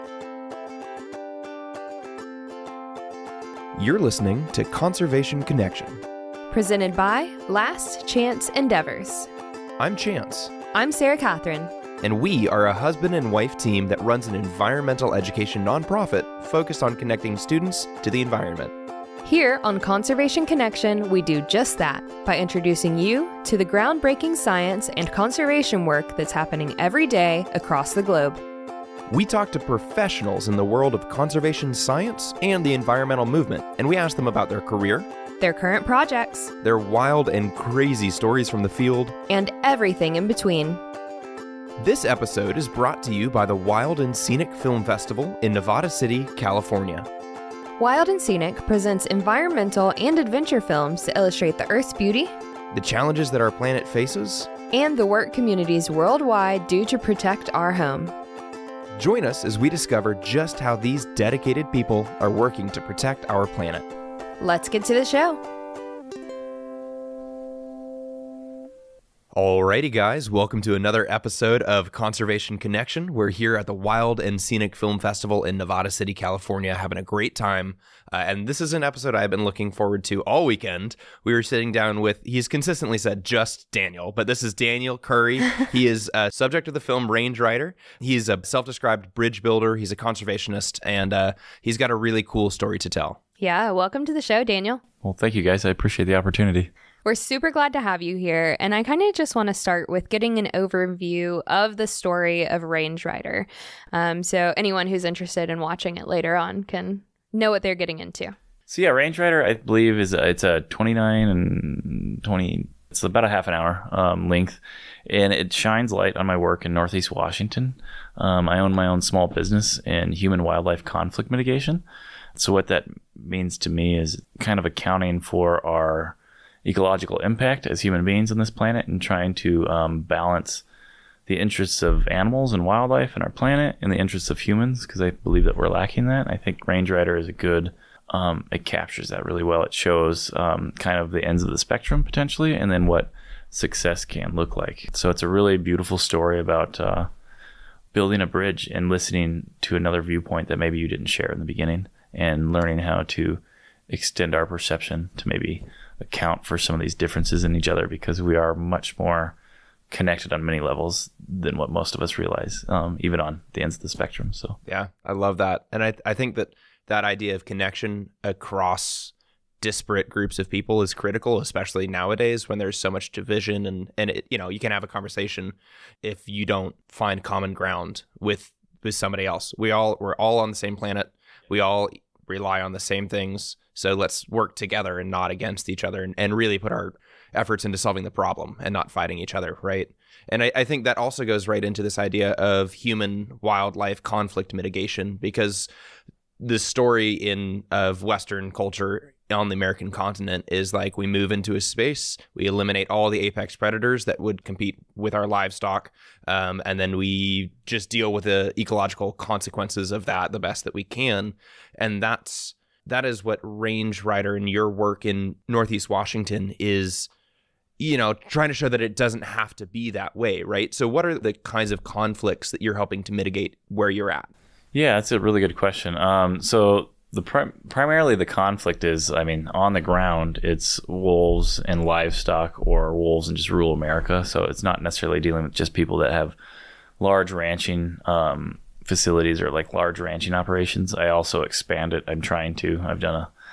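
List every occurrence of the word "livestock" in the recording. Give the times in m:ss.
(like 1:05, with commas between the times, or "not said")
3:25, 3:51.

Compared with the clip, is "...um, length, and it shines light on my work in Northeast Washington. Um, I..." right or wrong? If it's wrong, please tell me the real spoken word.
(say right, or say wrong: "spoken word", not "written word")
right.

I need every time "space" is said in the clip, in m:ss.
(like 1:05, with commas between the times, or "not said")
3:21.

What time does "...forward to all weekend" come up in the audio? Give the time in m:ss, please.
1:19.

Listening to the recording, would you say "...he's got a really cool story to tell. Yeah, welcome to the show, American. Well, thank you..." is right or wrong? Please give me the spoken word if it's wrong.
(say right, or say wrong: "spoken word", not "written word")
wrong: "Daniel", not "American".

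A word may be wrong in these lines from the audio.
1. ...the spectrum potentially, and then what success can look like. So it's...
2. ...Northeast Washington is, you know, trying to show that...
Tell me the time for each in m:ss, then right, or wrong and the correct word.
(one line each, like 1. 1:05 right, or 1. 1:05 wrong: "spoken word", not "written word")
1. 2:21 right
2. 3:35 right.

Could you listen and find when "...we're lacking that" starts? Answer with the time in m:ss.
2:15.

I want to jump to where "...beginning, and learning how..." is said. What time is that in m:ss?
2:31.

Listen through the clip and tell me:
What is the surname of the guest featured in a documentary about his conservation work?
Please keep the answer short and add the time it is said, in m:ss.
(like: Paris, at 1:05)
Curry, at 1:24.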